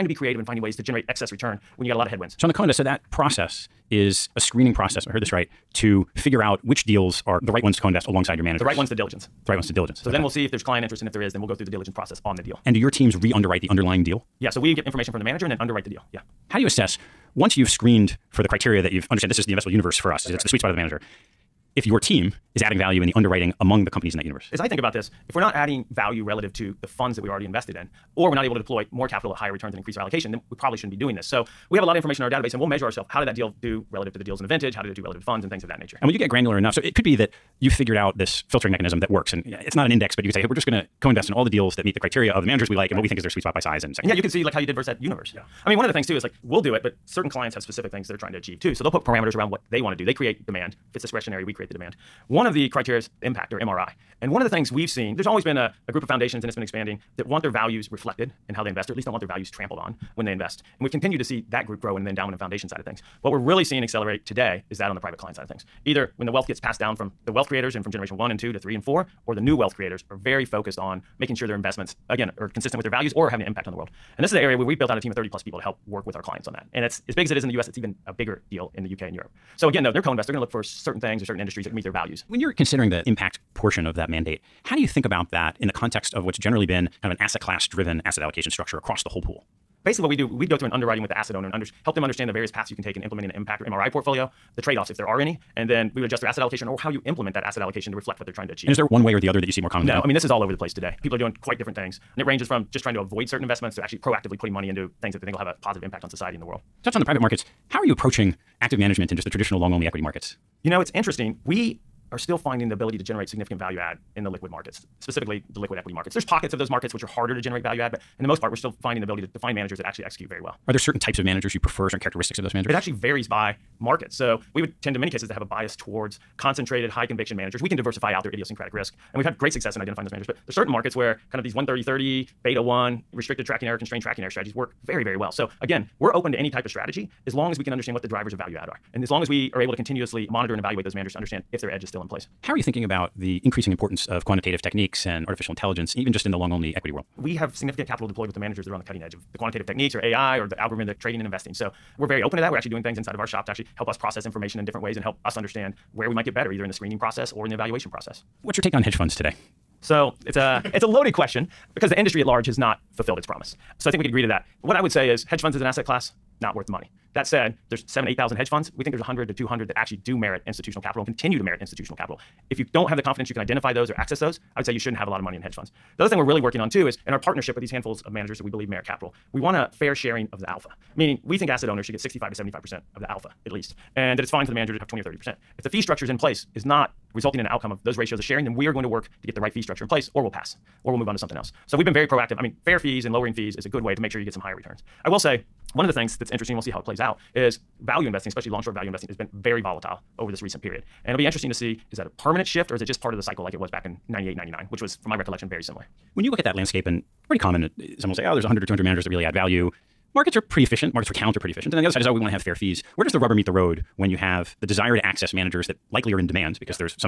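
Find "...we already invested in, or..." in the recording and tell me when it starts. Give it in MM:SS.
00:27.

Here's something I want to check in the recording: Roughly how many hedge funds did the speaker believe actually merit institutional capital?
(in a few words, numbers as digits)
100 to 200.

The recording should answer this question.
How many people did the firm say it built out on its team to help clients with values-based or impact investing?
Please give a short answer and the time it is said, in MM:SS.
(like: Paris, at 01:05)
30+, at 01:15.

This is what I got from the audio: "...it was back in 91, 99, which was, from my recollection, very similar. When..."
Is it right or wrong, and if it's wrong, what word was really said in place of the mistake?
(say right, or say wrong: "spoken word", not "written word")
wrong: "98", not "91".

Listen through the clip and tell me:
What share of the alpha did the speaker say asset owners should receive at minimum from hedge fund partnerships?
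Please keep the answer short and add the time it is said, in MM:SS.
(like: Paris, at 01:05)
65 to 75%, at 03:01.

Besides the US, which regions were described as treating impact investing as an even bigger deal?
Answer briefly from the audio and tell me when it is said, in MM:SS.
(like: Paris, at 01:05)
UK and Europe, at 01:18.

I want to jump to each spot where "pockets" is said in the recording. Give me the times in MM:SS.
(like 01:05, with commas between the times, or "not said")
01:56.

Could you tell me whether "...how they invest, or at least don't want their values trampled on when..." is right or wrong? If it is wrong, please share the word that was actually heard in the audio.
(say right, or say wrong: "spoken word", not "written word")
right.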